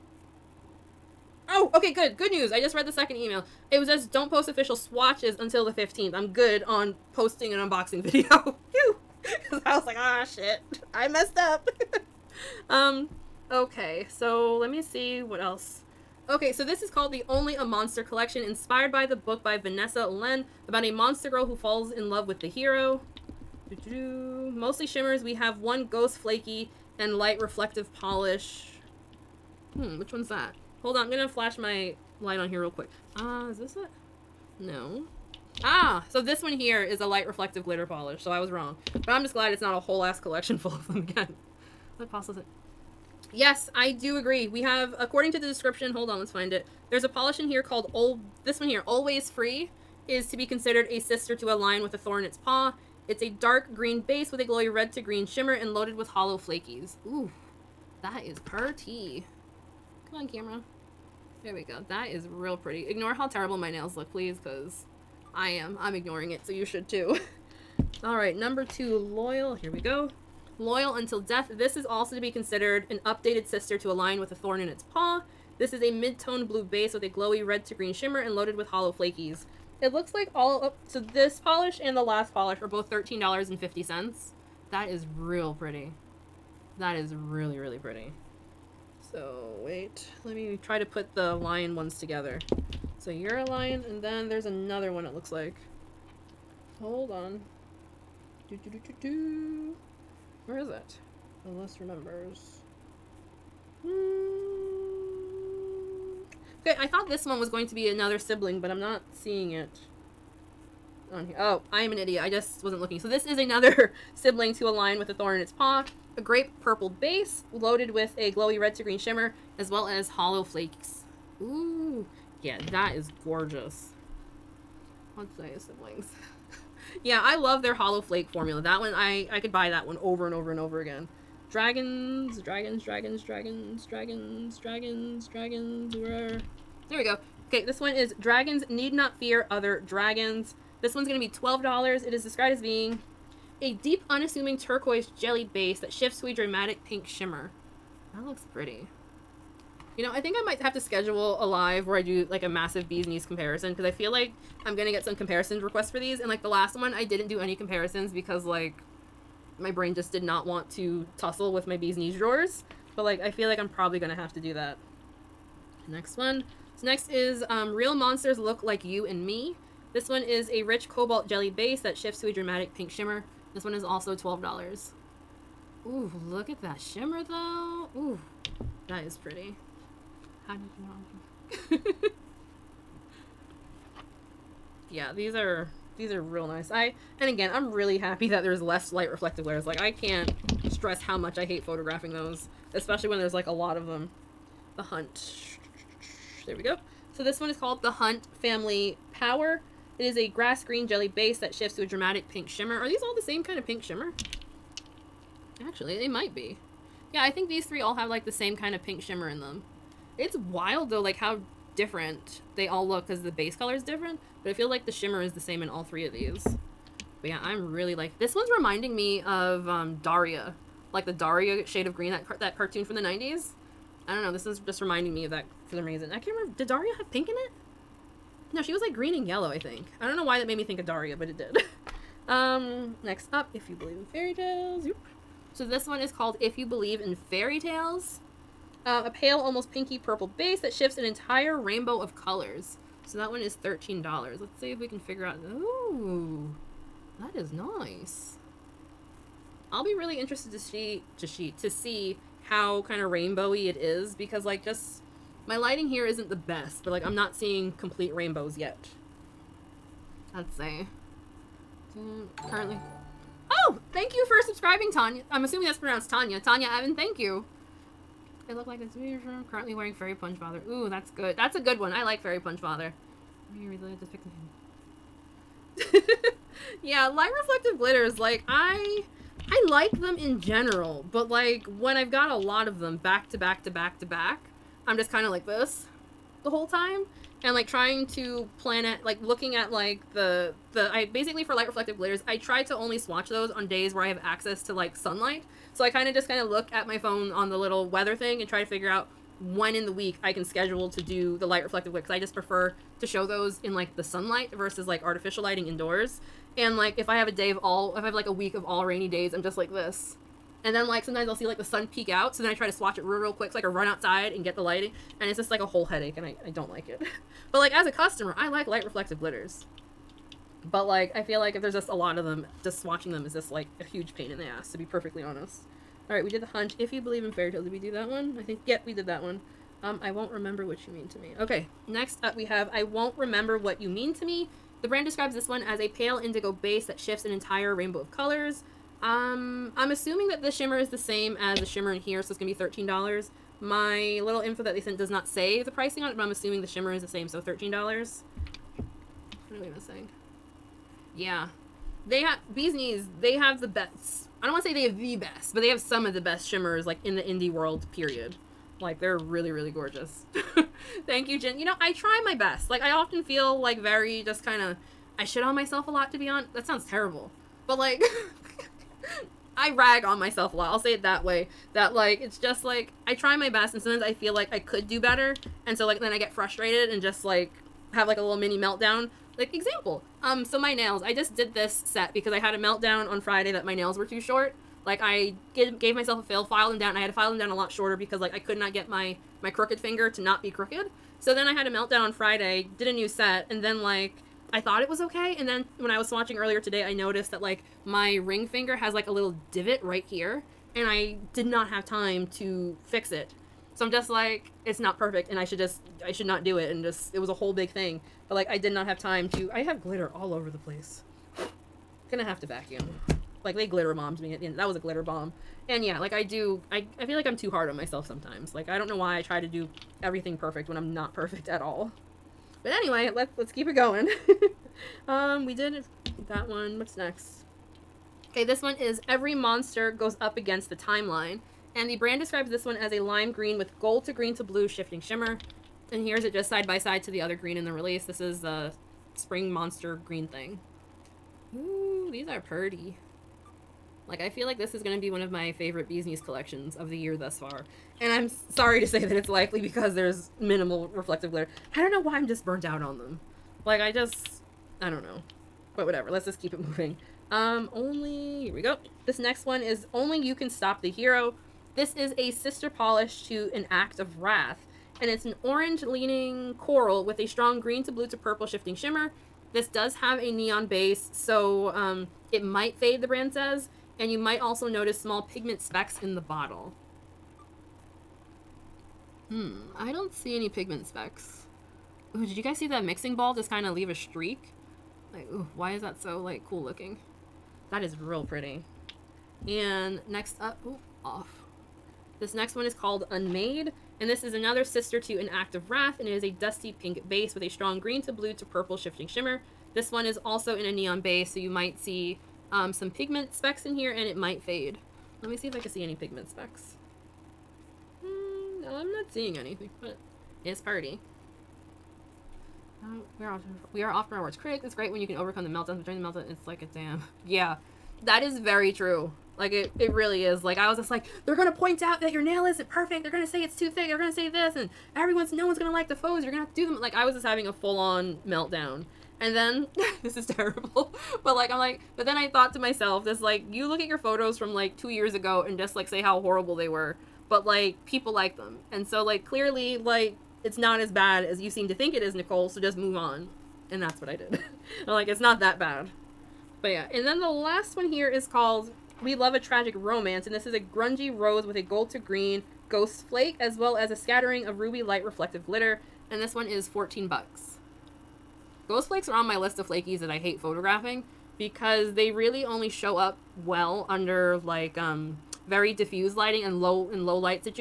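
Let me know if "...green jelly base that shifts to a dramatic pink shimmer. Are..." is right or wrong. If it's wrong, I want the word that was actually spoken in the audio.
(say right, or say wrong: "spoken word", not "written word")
right.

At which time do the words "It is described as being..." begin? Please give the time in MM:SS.
02:22.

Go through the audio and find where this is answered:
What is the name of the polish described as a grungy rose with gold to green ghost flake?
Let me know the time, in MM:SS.
09:09.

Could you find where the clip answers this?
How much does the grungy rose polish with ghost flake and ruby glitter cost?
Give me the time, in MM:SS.
09:16.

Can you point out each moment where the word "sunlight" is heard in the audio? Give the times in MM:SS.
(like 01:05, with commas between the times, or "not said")
04:54, 05:04.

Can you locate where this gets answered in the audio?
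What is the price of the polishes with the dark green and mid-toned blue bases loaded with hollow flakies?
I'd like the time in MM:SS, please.
01:22.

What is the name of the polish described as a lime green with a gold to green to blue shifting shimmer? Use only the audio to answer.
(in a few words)
Every Monster Goes Up Against the Timeline.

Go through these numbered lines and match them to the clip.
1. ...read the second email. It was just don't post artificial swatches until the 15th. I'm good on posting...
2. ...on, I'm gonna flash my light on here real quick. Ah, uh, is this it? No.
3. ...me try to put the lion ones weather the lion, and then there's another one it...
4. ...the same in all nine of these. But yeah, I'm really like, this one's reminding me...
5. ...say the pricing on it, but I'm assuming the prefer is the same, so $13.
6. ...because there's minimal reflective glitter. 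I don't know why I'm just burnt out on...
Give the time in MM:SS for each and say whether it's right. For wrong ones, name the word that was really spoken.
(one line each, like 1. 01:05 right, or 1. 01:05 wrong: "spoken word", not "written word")
1. 00:02 wrong: "official", not "artificial"
2. 00:30 right
3. 01:30 wrong: "together", not "weather"
4. 03:35 wrong: "three", not "nine"
5. 05:45 wrong: "shimmer", not "prefer"
6. 07:29 right.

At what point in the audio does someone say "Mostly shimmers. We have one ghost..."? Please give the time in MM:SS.
00:24.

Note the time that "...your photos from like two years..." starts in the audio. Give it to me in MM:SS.
08:53.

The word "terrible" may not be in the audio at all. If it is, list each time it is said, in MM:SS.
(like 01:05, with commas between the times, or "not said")
01:03, 06:06, 08:50.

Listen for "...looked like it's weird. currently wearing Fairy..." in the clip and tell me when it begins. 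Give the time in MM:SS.
04:28.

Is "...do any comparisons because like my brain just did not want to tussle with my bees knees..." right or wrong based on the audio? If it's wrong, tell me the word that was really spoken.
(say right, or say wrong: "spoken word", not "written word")
right.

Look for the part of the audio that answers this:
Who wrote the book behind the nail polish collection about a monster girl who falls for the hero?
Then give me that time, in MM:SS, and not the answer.
00:19.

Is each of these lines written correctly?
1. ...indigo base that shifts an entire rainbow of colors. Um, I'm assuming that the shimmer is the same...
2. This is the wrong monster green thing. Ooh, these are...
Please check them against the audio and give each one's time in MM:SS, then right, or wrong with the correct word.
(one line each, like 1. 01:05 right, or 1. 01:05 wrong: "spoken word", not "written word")
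1. 05:36 right
2. 07:18 wrong: "spring", not "wrong".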